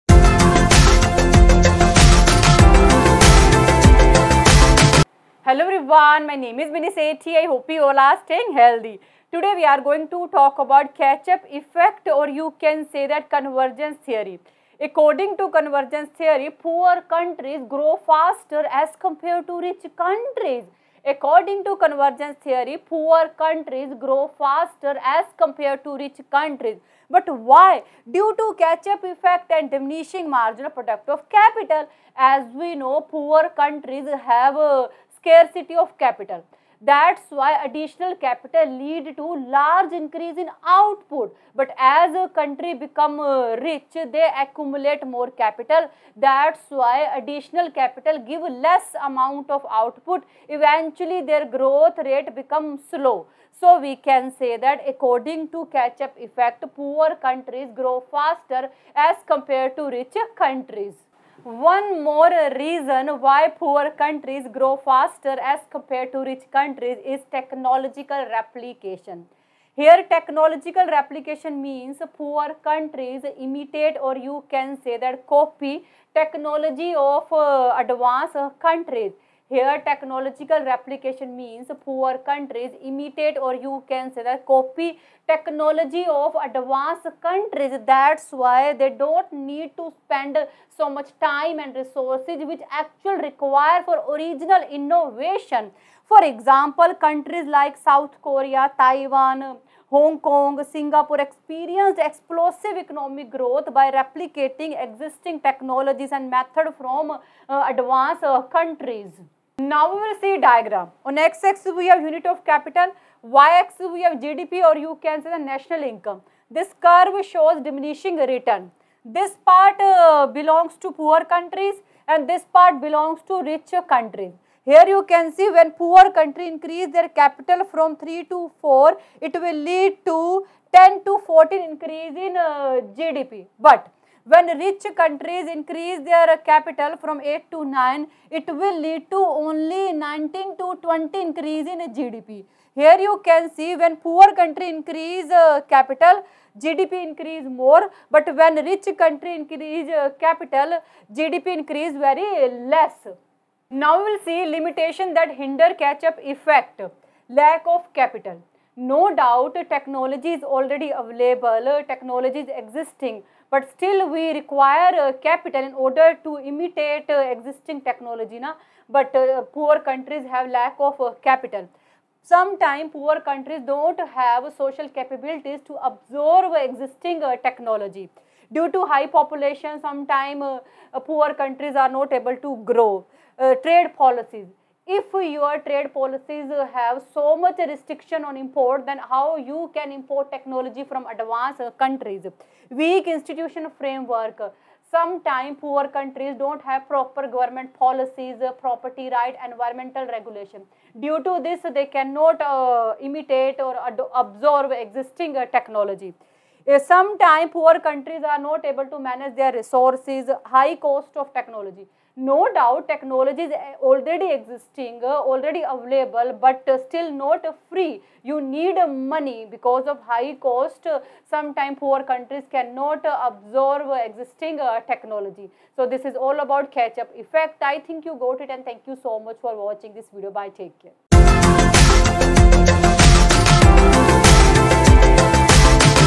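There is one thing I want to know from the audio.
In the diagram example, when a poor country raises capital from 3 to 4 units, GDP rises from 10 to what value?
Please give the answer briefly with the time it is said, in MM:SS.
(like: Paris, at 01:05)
14, at 02:11.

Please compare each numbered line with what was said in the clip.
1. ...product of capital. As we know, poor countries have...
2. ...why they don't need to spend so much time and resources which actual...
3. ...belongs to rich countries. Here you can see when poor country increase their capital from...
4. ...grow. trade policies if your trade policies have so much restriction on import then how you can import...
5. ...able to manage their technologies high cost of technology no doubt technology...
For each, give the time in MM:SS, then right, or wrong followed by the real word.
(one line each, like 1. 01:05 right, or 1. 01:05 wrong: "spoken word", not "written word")
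1. 00:30 right
2. 01:28 right
3. 02:02 right
4. 03:02 right
5. 03:28 wrong: "resources", not "technologies".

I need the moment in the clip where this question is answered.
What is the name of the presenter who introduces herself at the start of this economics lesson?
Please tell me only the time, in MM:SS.
00:06.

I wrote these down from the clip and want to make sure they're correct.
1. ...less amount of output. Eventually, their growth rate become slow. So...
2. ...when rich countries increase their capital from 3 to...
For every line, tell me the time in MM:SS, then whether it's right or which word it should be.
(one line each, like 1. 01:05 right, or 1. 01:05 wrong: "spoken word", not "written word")
1. 00:48 right
2. 02:14 wrong: "8", not "3".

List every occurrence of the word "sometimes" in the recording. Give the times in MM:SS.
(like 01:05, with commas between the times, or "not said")
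02:52, 02:59, 03:14, 03:26, 03:41.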